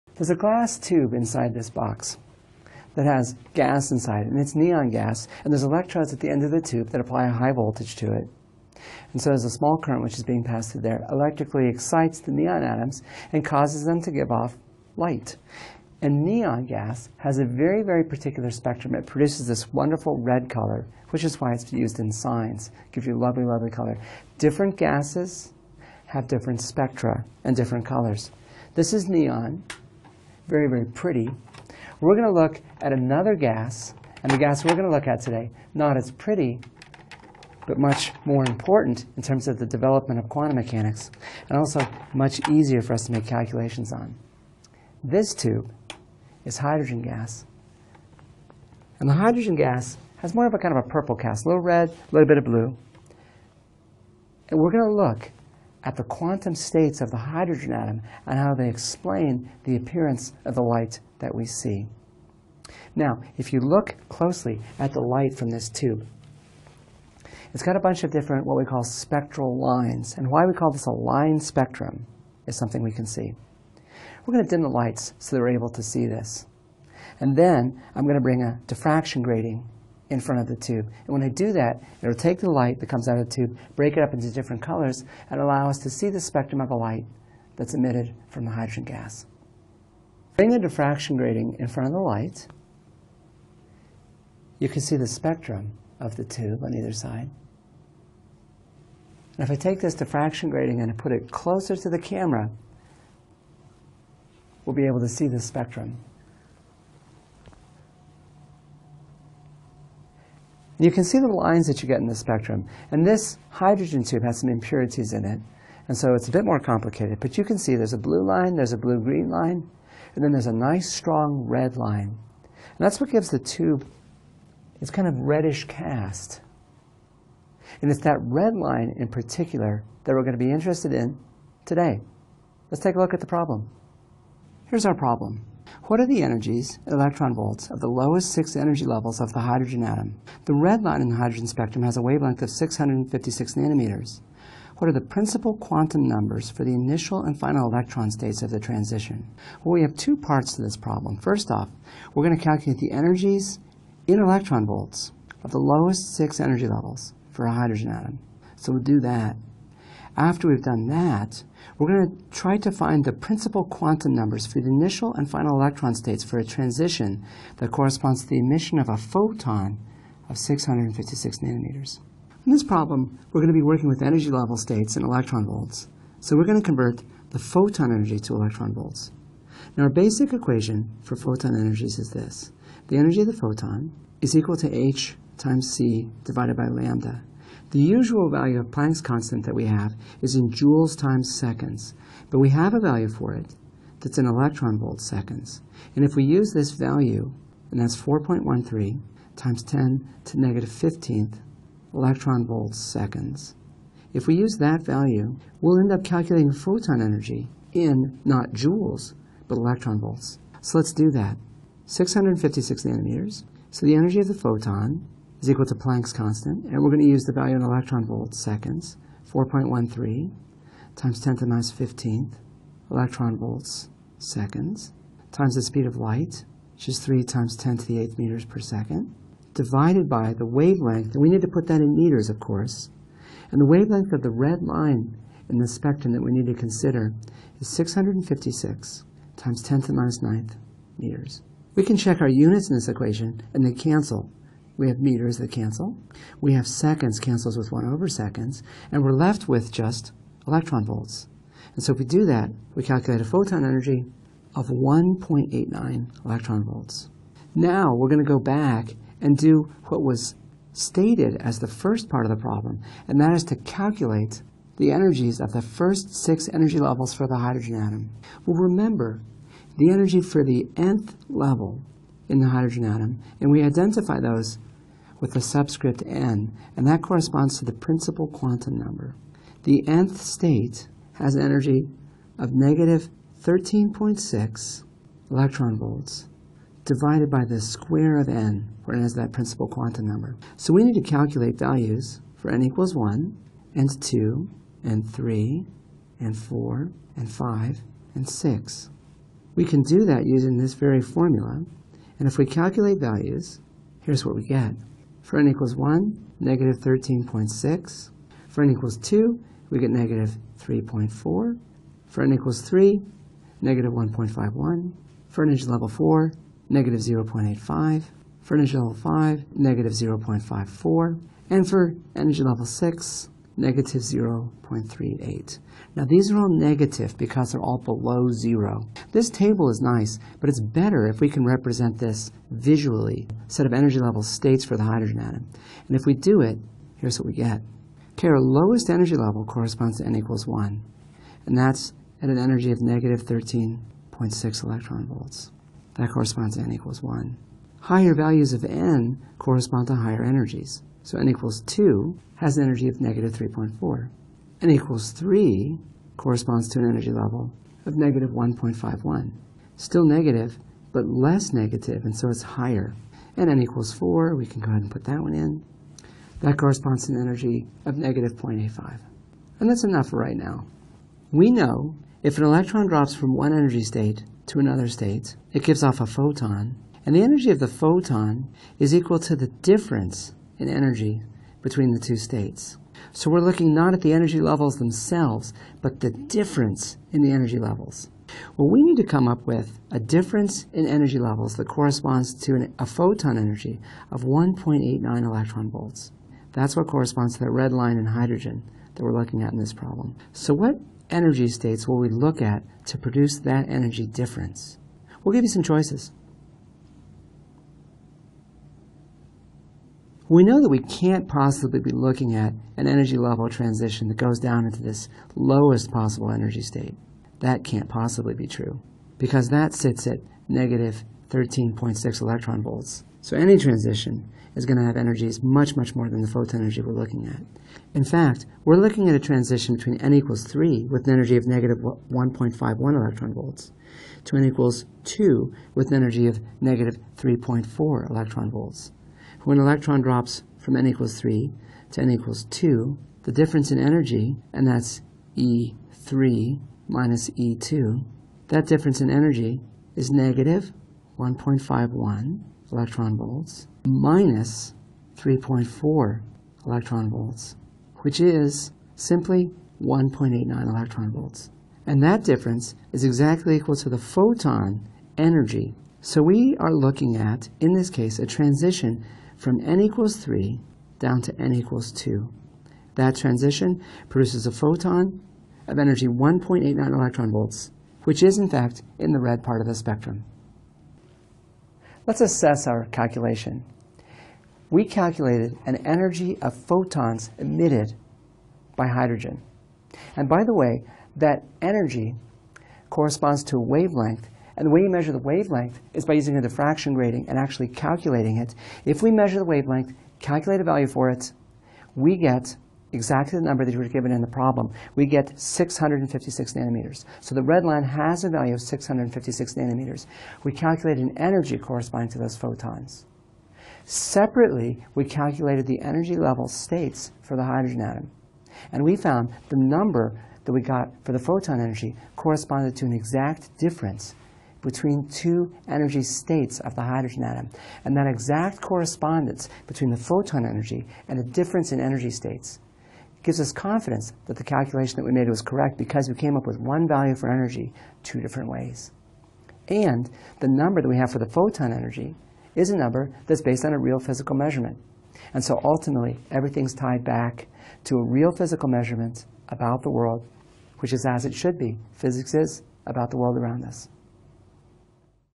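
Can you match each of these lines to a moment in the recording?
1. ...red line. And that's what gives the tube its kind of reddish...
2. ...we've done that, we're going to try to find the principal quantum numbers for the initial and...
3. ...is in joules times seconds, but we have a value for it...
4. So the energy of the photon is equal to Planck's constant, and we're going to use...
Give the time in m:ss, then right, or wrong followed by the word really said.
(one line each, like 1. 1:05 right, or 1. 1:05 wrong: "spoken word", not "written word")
1. 2:01 right
2. 2:40 right
3. 3:10 right
4. 3:33 right.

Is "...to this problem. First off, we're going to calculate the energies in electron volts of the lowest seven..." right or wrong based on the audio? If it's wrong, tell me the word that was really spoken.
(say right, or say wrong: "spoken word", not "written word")
wrong: "six", not "seven".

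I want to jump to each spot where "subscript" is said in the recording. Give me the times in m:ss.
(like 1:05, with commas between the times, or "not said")
4:35.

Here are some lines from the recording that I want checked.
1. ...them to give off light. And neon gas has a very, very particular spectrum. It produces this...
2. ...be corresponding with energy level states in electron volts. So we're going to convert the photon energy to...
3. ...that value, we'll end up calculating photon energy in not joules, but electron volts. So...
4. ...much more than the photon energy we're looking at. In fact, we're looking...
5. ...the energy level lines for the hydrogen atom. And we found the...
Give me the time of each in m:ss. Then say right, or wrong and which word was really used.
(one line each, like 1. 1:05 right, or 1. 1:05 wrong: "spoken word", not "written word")
1. 0:13 right
2. 2:53 wrong: "working", not "corresponding"
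3. 3:24 right
4. 7:05 right
5. 8:35 wrong: "states", not "lines".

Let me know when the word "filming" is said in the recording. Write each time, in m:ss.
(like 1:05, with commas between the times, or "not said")
not said.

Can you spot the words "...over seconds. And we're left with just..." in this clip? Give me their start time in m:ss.
4:07.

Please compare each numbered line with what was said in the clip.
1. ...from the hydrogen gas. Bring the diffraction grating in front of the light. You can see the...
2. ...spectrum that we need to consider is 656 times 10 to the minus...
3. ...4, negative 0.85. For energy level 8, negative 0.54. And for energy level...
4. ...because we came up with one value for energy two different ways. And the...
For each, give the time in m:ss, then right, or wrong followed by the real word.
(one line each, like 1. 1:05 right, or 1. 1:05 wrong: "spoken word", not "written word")
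1. 1:28 right
2. 3:55 right
3. 5:15 wrong: "5", not "8"
4. 8:55 right.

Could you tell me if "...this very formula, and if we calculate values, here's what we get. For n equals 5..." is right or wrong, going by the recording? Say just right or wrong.
wrong.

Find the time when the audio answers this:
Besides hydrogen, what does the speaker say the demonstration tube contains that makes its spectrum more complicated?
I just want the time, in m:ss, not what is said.
1:54.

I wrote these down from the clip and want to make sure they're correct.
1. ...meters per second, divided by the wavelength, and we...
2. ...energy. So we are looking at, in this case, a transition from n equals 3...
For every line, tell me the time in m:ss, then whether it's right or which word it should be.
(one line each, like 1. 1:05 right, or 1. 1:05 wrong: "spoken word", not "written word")
1. 3:48 right
2. 7:45 right.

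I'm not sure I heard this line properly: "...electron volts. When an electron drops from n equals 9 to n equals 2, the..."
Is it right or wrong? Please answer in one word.
wrong.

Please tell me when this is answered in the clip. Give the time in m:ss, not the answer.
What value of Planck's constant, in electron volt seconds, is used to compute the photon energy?
3:17.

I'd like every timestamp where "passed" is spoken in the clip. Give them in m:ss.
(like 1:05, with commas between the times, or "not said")
0:10.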